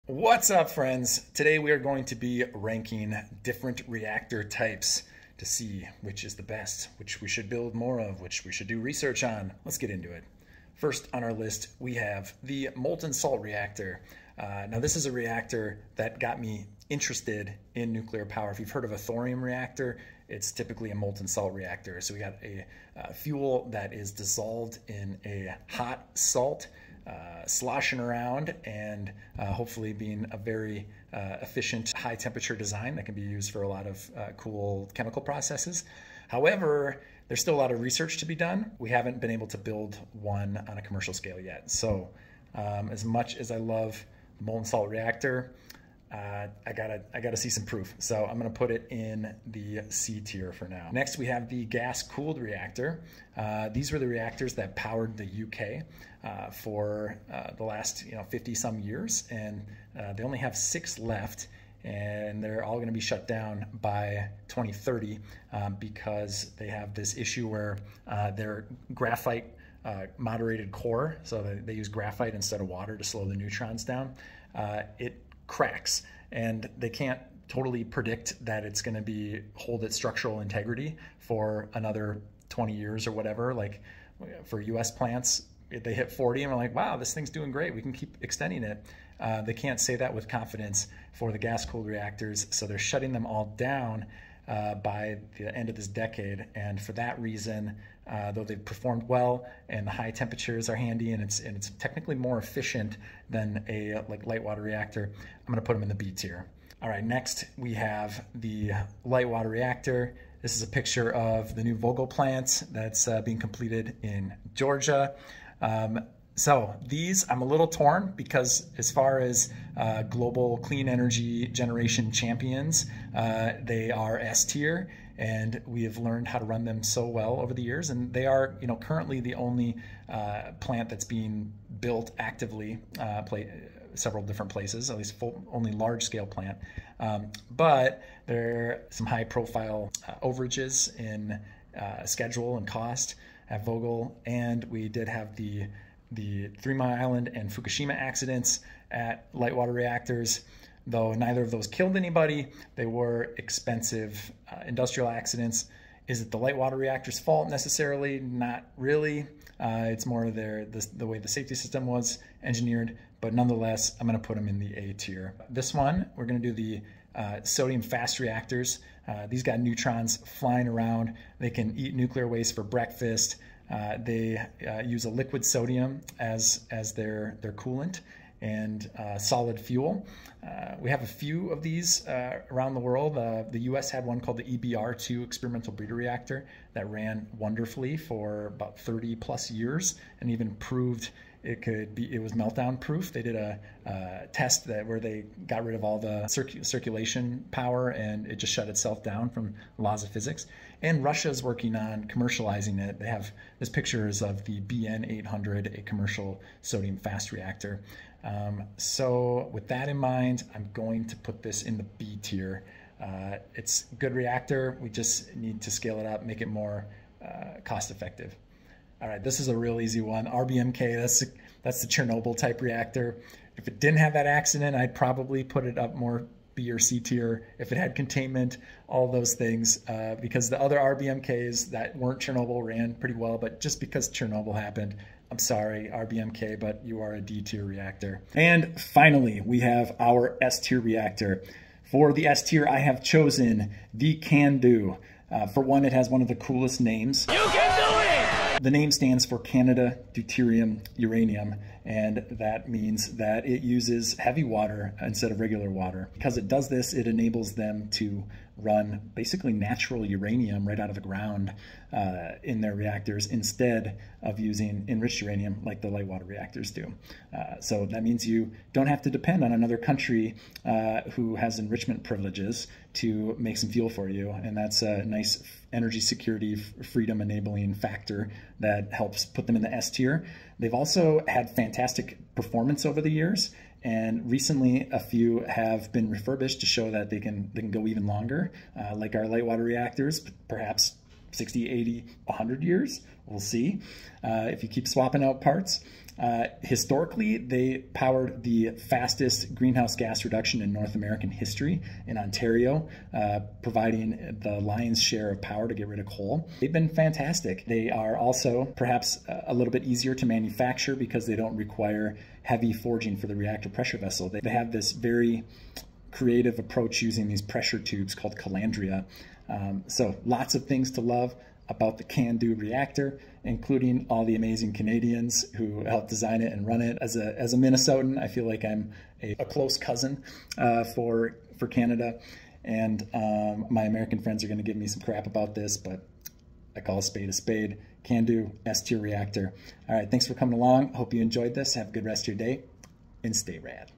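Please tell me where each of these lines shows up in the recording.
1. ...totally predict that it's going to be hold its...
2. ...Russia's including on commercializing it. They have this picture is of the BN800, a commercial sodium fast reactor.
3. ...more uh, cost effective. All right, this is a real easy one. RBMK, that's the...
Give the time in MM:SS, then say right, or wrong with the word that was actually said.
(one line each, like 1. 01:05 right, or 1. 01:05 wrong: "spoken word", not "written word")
1. 01:17 right
2. 03:21 wrong: "working", not "including"
3. 03:36 right.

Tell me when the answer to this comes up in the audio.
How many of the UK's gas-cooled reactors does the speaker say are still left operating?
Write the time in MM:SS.
01:00.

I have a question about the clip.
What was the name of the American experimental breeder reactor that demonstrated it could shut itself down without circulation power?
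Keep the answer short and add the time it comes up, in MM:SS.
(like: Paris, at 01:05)
EBR2, at 03:04.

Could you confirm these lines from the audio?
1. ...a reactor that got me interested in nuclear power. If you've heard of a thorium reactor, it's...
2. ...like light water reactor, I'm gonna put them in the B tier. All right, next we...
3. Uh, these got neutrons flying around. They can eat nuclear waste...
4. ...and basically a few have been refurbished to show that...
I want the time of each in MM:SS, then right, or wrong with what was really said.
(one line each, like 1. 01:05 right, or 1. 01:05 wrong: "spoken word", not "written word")
1. 00:15 right
2. 01:44 right
3. 02:49 right
4. 04:43 wrong: "recently", not "basically".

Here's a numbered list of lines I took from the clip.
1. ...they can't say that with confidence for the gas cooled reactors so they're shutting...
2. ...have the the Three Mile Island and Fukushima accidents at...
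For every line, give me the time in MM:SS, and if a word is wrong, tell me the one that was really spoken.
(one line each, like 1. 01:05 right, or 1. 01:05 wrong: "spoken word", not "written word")
1. 01:29 right
2. 02:25 right.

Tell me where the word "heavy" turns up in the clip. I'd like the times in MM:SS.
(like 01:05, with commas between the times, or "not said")
04:14, 05:12.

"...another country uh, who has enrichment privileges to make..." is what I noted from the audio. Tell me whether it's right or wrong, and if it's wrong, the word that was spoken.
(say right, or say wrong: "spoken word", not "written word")
right.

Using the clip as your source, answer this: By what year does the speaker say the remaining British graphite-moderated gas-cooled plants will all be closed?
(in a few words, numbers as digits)
2030.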